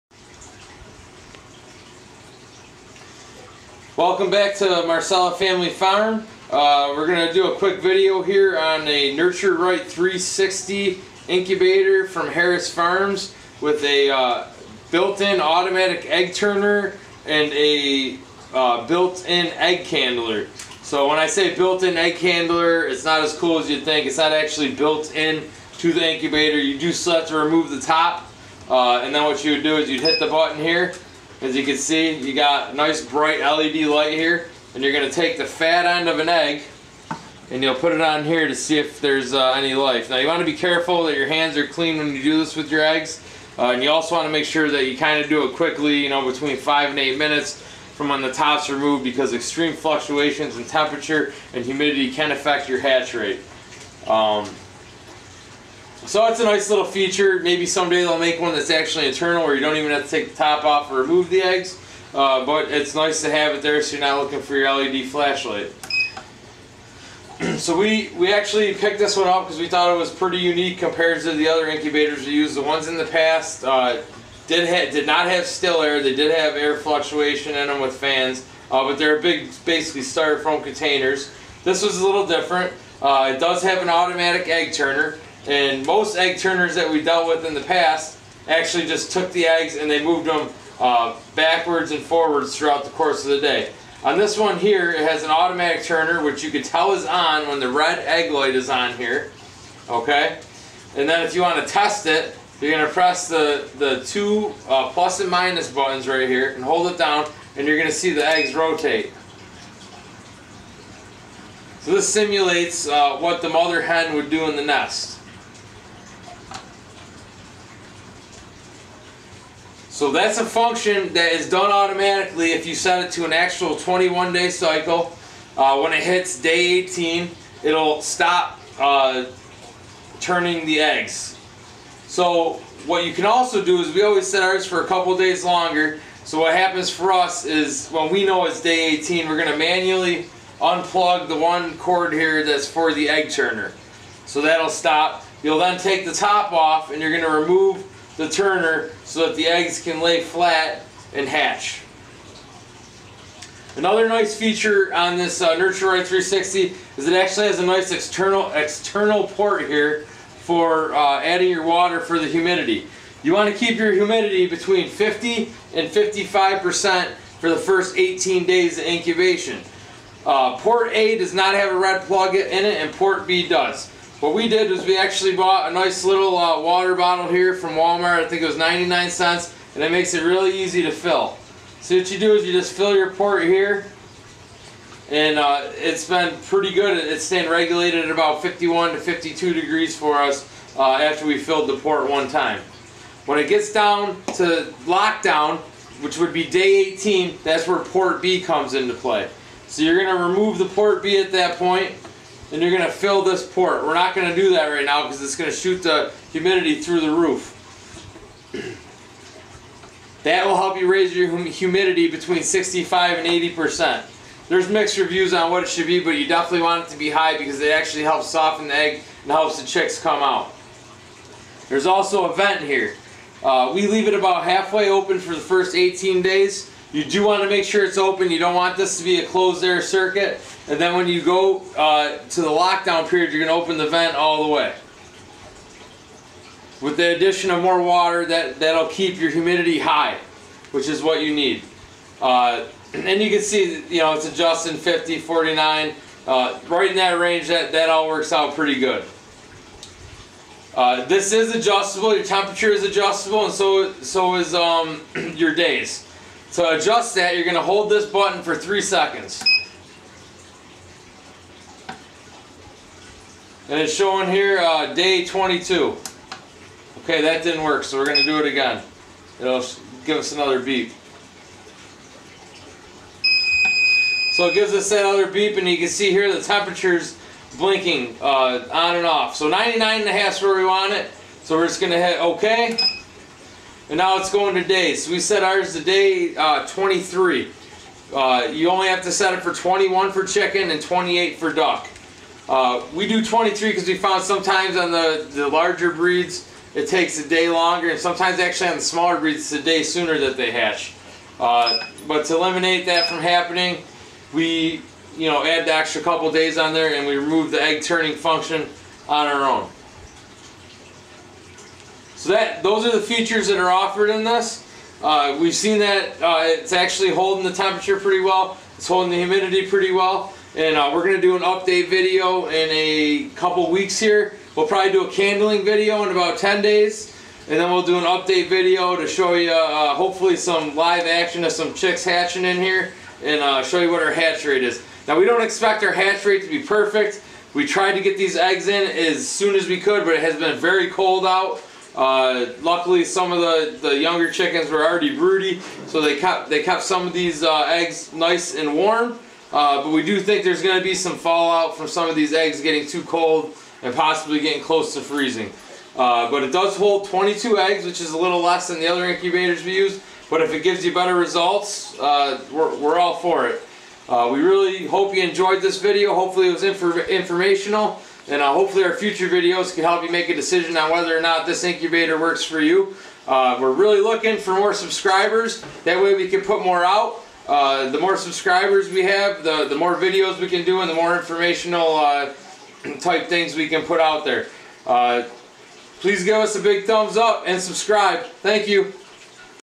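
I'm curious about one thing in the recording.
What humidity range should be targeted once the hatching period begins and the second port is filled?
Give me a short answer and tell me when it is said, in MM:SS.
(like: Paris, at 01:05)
65 to 80%, at 03:32.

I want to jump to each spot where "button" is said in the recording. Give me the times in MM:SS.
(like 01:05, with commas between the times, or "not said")
00:30, 01:45, 04:18.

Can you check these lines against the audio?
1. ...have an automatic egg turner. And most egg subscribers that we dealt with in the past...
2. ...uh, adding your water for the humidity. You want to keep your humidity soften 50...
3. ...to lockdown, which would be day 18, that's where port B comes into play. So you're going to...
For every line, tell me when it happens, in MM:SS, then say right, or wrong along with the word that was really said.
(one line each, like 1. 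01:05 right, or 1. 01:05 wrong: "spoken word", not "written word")
1. 01:23 wrong: "turners", not "subscribers"
2. 02:40 wrong: "between", not "soften"
3. 03:14 right.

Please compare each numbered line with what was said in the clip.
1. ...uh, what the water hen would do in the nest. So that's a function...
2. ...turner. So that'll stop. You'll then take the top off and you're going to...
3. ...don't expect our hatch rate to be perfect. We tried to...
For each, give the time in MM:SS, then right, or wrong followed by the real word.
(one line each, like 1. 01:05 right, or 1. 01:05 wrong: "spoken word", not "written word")
1. 01:52 wrong: "mother", not "water"
2. 02:23 right
3. 05:35 right.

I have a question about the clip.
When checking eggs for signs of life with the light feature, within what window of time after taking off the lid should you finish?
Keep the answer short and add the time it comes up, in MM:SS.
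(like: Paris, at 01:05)
5 to 8 minutes, at 00:46.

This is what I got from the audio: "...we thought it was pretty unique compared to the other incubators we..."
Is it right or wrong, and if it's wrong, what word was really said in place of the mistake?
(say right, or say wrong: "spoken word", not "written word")
right.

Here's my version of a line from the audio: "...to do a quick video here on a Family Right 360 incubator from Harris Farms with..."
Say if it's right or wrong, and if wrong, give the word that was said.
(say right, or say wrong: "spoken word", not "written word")
wrong: "Nurture", not "Family".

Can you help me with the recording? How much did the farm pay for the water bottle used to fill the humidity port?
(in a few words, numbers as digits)
99 cents.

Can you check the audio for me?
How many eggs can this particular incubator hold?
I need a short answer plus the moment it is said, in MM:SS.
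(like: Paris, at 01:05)
22, at 05:57.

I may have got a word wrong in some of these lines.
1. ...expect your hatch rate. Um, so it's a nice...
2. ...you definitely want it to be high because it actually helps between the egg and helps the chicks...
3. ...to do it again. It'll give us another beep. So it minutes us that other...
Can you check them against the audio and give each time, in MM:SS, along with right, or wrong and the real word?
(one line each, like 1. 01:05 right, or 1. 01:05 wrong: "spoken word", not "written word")
1. 00:52 wrong: "affect", not "expect"
2. 03:36 wrong: "soften", not "between"
3. 04:28 wrong: "gives", not "minutes".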